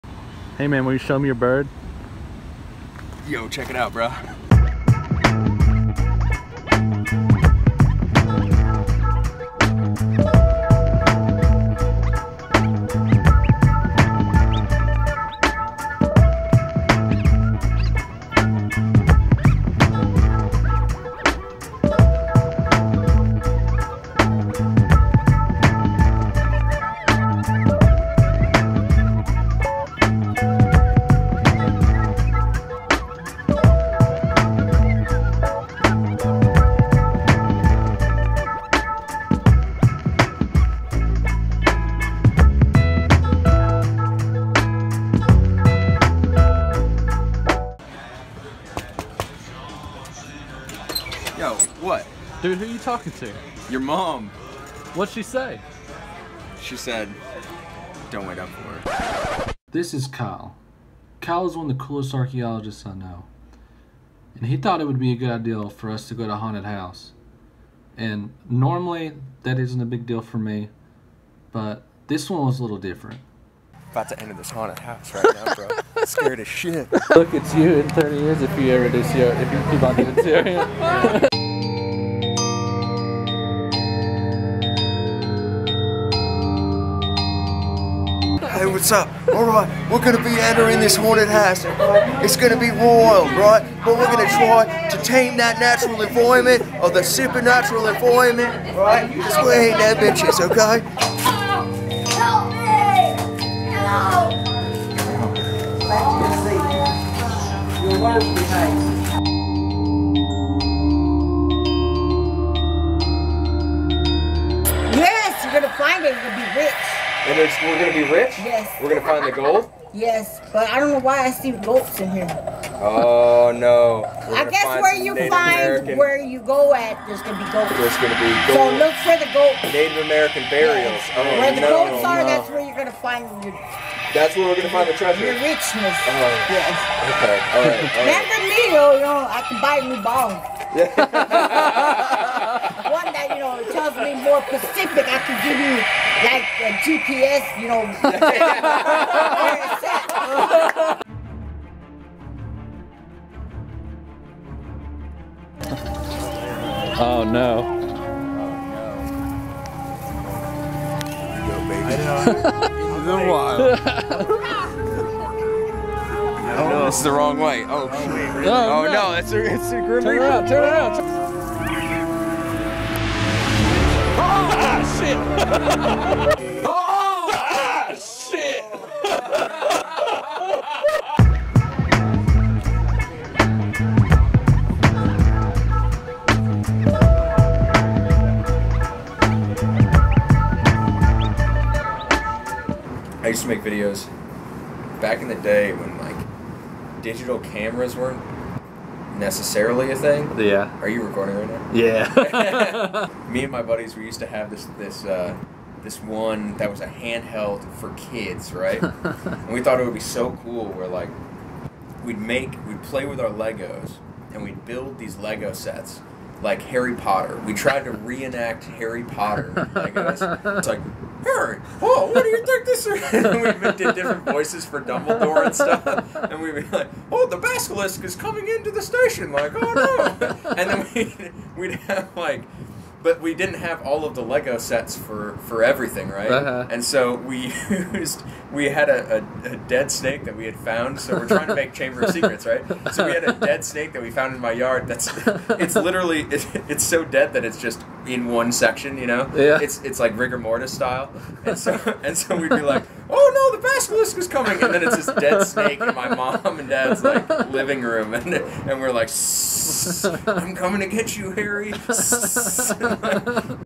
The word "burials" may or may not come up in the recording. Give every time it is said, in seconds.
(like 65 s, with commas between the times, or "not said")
130 s.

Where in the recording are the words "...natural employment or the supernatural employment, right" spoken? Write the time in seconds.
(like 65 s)
95 s.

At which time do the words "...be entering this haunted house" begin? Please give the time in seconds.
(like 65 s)
90 s.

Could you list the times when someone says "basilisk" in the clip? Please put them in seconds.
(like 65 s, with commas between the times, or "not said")
227 s, 253 s.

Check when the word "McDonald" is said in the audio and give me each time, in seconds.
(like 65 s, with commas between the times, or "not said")
not said.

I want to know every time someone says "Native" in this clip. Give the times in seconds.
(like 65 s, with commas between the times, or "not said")
125 s, 129 s.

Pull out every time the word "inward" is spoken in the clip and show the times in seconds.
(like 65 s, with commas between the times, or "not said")
not said.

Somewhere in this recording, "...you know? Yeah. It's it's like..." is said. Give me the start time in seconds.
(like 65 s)
248 s.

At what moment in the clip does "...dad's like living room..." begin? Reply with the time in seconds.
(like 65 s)
256 s.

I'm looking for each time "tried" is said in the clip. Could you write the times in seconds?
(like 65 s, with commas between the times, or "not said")
217 s.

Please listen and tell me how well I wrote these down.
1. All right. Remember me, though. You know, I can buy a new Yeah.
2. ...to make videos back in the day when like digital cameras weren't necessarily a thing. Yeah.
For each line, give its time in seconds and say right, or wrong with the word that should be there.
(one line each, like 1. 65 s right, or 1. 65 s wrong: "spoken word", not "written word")
1. 137 s right
2. 193 s right.